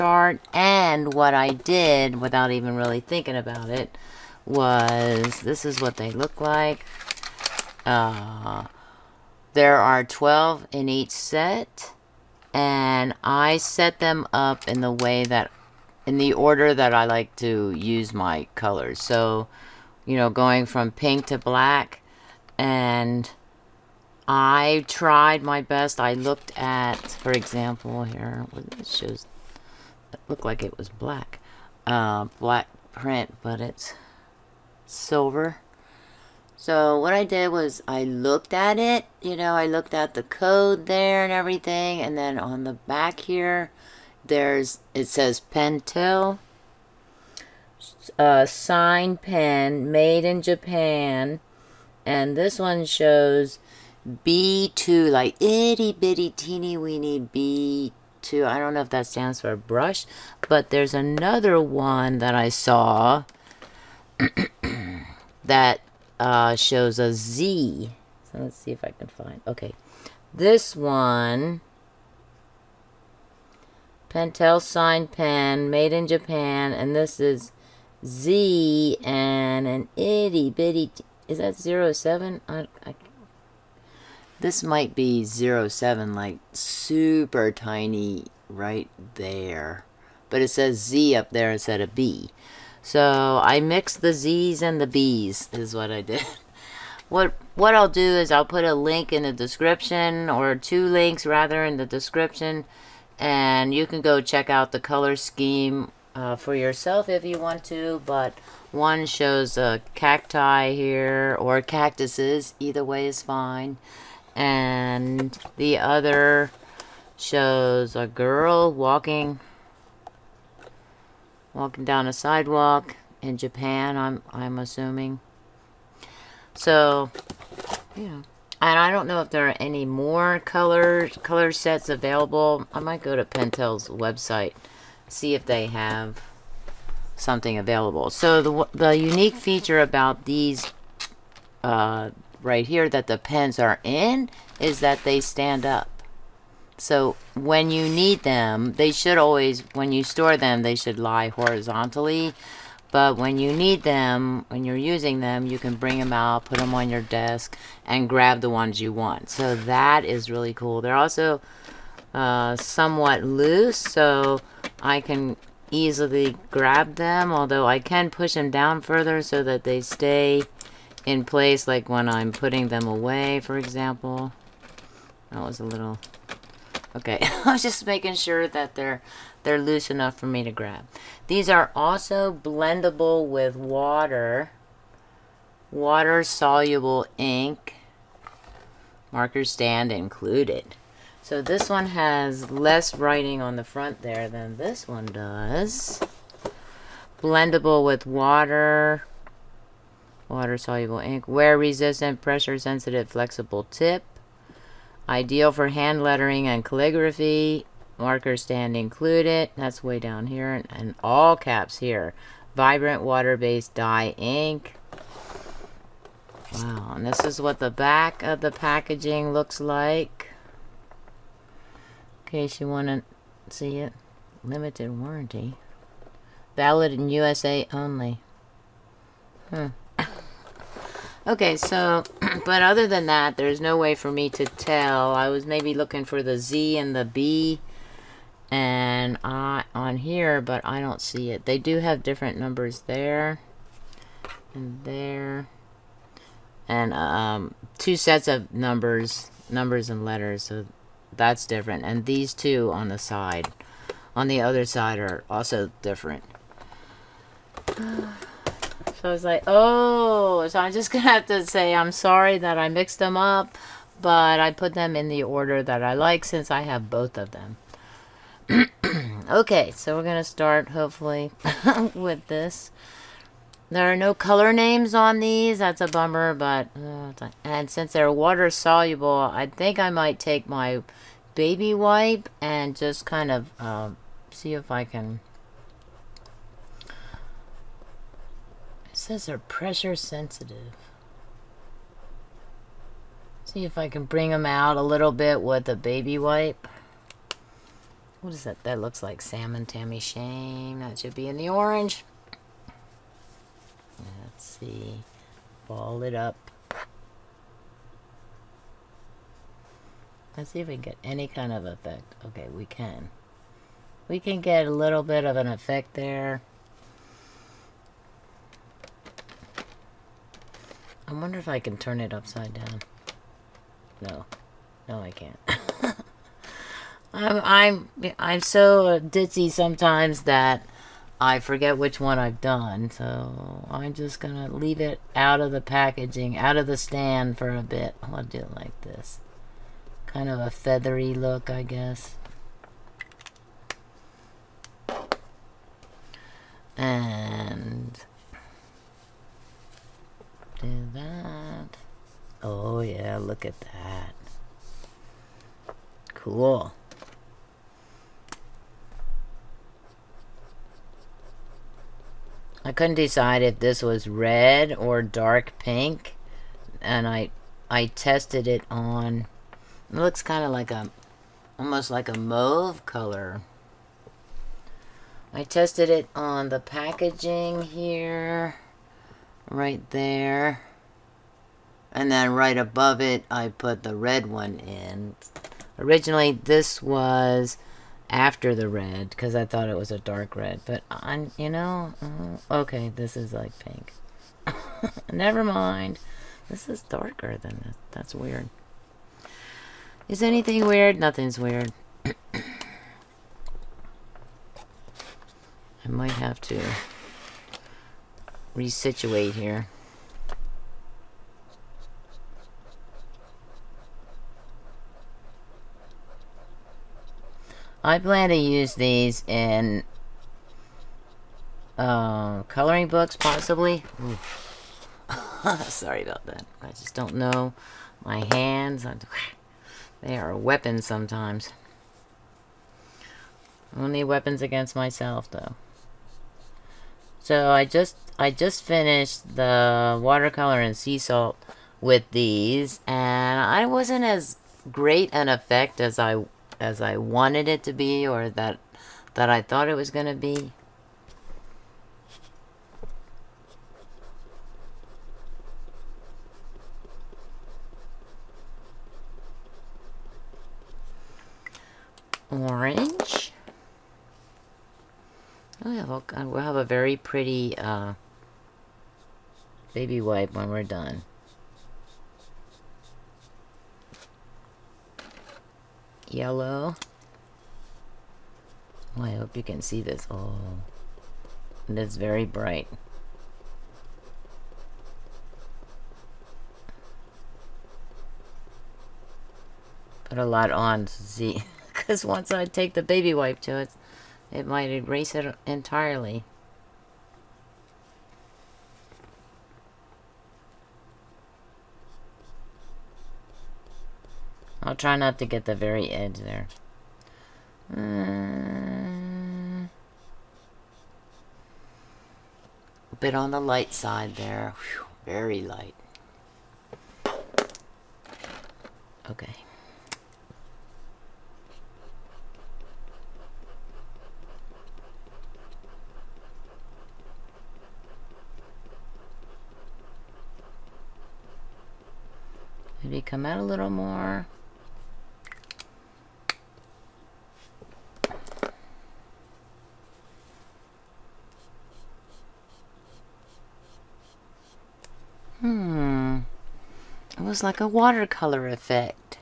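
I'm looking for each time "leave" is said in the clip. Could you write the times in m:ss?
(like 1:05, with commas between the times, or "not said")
5:34.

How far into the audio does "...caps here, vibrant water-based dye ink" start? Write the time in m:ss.
3:31.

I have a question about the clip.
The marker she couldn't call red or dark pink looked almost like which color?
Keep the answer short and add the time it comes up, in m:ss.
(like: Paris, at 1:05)
mauve, at 6:12.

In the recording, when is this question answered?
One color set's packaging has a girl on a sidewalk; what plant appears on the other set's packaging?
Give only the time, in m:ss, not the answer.
1:49.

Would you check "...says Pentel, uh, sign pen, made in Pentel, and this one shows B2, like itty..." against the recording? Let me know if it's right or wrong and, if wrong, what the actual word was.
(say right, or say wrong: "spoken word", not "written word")
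wrong: "Japan", not "Pentel".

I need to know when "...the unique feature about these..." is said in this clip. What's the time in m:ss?
2:18.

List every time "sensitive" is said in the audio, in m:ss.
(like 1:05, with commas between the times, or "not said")
3:22, 4:49.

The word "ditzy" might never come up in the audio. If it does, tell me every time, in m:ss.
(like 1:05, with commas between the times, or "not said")
5:29.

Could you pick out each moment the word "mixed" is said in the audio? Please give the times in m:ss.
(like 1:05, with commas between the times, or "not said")
1:33, 4:22.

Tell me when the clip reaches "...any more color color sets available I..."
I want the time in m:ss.
2:09.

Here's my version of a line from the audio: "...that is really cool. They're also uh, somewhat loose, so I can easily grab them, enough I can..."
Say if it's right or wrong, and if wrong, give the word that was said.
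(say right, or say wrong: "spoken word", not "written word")
wrong: "although", not "enough".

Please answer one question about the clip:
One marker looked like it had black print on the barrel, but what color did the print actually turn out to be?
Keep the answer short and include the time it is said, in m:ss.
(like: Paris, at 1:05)
silver, at 0:34.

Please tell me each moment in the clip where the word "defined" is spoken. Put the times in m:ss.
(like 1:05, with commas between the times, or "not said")
not said.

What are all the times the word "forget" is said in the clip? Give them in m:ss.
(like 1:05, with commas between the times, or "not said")
5:31.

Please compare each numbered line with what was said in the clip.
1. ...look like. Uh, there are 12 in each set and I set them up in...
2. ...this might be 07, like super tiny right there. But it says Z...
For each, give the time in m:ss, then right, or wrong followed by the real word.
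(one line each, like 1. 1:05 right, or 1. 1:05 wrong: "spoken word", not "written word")
1. 0:06 right
2. 1:24 right.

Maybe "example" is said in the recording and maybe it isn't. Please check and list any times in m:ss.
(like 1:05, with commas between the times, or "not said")
0:27, 2:53.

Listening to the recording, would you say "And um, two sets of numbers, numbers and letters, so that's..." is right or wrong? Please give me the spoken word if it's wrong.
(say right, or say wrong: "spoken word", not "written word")
right.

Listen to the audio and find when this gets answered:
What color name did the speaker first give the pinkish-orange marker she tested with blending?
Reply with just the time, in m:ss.
4:59.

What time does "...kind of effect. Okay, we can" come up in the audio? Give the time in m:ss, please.
5:11.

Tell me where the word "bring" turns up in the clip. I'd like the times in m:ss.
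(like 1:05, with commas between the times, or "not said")
2:35, 4:54.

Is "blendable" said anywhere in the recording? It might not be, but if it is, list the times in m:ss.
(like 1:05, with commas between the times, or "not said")
3:02, 3:17.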